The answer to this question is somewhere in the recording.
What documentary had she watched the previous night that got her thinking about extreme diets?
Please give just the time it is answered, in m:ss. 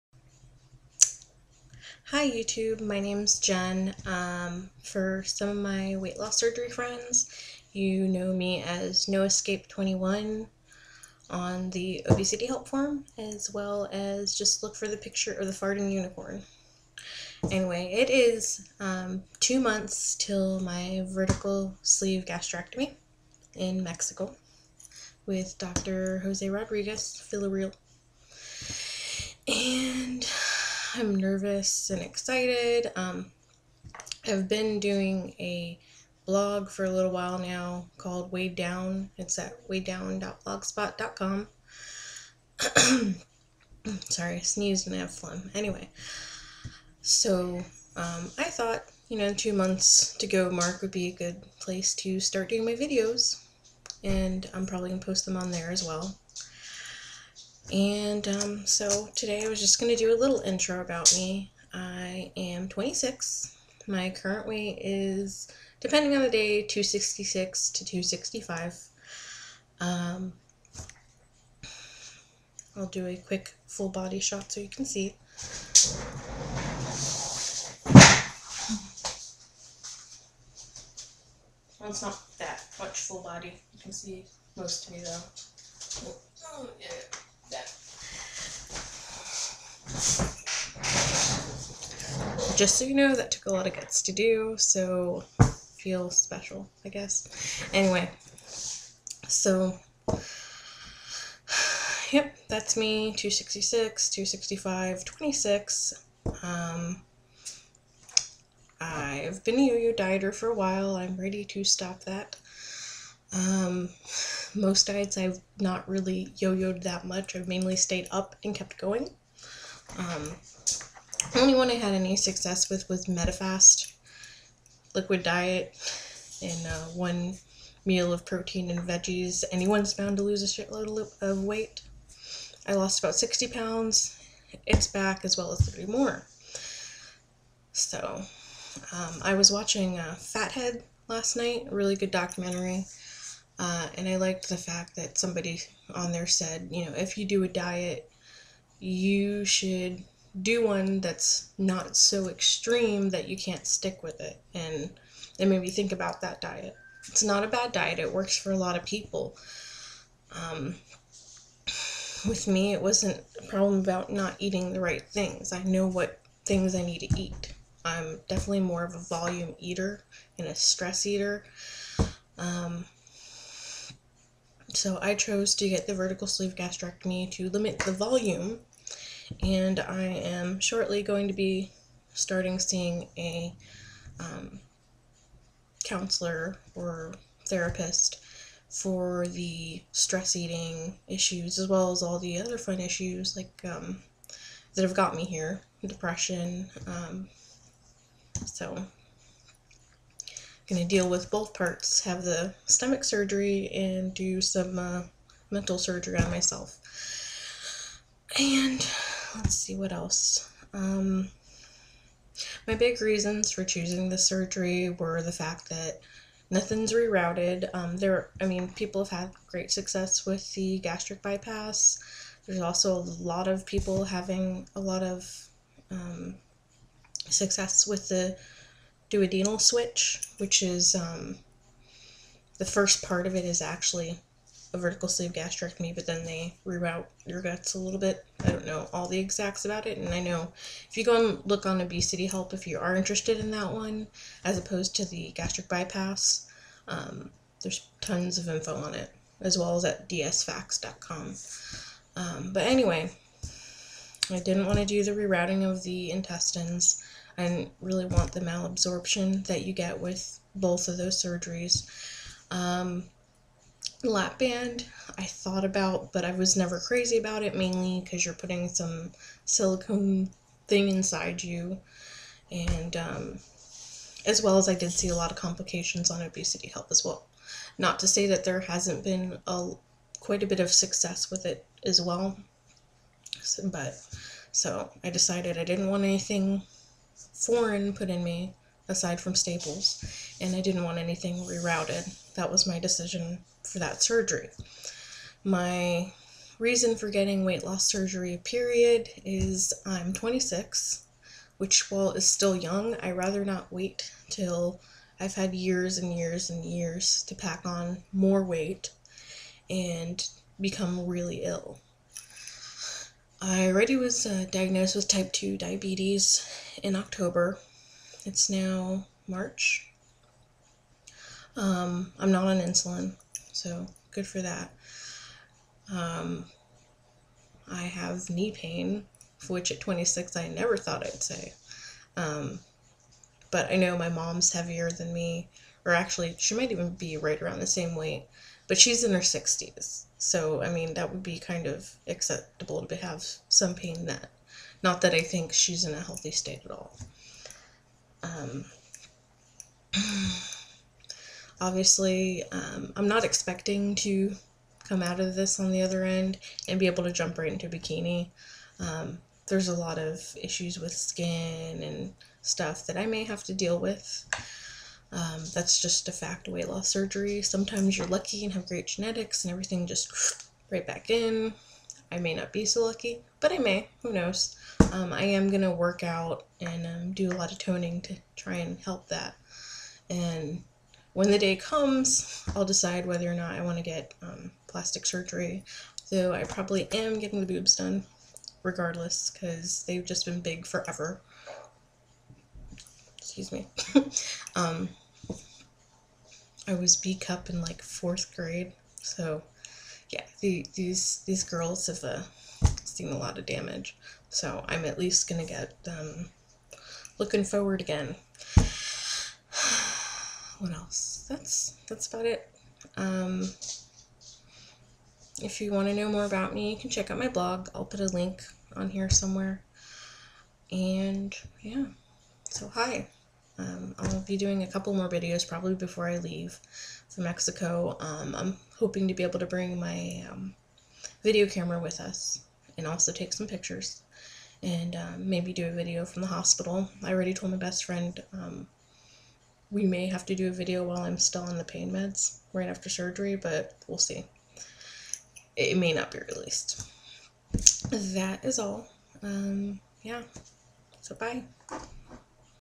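2:20.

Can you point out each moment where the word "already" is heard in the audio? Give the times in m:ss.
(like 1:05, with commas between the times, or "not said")
5:13, 7:17.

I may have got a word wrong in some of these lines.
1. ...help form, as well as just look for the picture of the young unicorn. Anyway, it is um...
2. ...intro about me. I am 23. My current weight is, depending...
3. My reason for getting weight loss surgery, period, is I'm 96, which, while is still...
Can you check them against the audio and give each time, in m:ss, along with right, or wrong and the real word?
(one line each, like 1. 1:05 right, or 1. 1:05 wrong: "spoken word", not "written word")
1. 0:12 wrong: "farting", not "young"
2. 1:00 wrong: "26", not "23"
3. 4:55 wrong: "26", not "96".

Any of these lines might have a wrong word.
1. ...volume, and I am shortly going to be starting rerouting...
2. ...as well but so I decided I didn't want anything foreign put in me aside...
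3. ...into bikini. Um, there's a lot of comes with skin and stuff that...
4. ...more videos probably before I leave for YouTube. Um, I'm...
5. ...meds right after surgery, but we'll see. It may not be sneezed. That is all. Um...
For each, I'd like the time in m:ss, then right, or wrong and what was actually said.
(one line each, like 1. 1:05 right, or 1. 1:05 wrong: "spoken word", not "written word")
1. 2:57 wrong: "seeing", not "rerouting"
2. 4:41 right
3. 5:57 wrong: "issues", not "comes"
4. 7:04 wrong: "Mexico", not "YouTube"
5. 7:21 wrong: "released", not "sneezed".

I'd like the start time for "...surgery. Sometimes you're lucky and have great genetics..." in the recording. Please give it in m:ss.
6:06.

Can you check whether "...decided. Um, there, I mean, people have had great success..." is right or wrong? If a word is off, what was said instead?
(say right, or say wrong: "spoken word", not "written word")
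wrong: "rerouted", not "decided".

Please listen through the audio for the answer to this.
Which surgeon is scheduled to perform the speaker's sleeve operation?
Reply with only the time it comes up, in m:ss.
0:25.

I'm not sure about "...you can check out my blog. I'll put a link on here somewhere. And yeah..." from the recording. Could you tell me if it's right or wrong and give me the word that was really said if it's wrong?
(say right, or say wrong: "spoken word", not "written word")
right.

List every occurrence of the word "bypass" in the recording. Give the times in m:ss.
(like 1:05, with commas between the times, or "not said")
3:41, 4:05.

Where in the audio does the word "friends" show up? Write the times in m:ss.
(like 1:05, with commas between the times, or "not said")
0:06, 7:17.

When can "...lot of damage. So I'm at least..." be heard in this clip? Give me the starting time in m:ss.
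6:43.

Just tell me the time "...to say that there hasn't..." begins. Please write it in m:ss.
4:37.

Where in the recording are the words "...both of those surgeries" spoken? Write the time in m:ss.
4:20.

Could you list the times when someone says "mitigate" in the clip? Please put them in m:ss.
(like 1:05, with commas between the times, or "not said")
not said.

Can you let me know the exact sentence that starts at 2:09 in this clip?
Anyone's bound to lose a shitload of weight.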